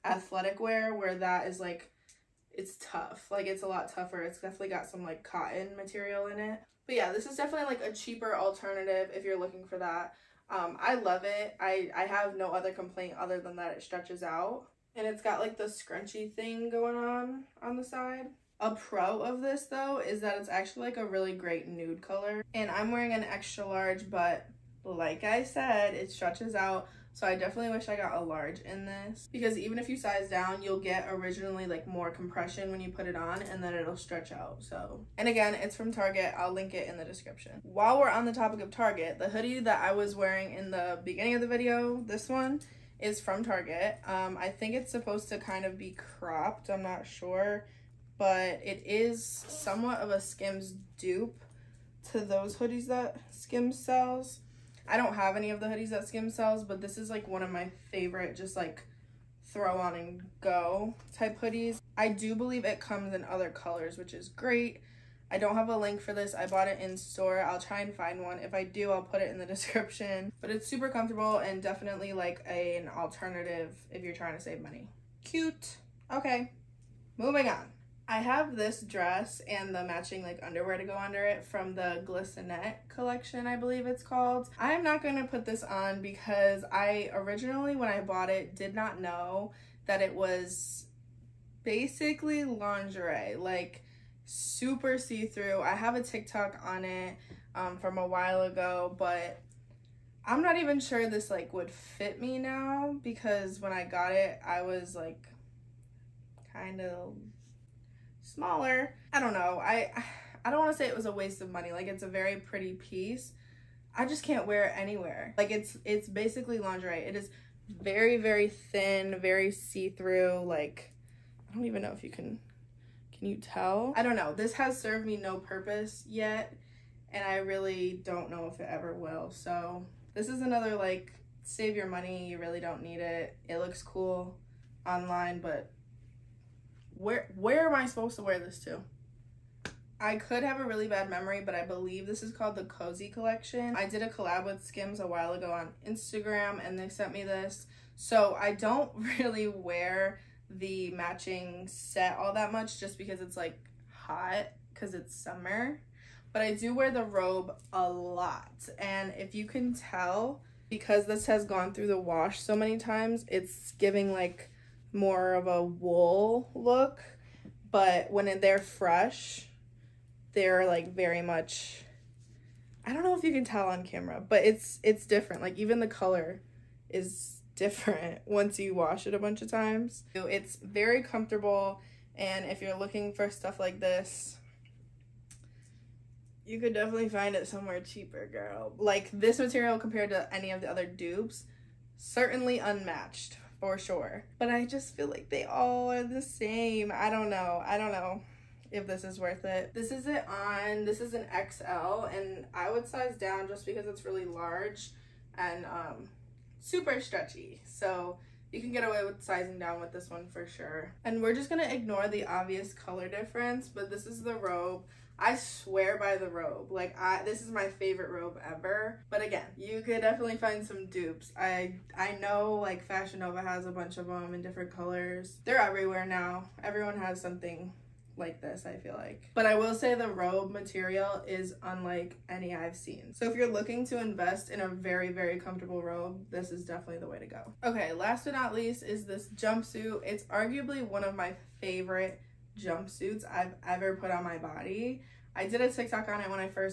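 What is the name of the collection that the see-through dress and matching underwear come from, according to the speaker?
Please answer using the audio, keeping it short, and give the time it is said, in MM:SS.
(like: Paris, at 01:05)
Glistenette collection, at 01:22.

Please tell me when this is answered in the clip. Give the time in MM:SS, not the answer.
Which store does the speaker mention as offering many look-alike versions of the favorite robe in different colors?
03:42.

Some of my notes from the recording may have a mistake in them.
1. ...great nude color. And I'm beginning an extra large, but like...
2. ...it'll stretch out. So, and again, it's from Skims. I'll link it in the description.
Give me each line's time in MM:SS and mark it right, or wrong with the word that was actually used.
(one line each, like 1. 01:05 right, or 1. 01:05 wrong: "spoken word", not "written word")
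1. 00:21 wrong: "wearing", not "beginning"
2. 00:33 wrong: "Target", not "Skims".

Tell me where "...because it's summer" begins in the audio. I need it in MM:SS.
02:34.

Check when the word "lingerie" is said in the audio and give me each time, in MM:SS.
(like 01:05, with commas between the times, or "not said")
01:32, 01:56.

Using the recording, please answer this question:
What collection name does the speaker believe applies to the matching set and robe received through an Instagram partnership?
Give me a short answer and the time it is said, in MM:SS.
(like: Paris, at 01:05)
Cozy Collection, at 02:22.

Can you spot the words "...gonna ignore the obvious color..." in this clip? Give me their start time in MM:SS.
03:31.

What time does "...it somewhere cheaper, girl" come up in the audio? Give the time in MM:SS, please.
03:07.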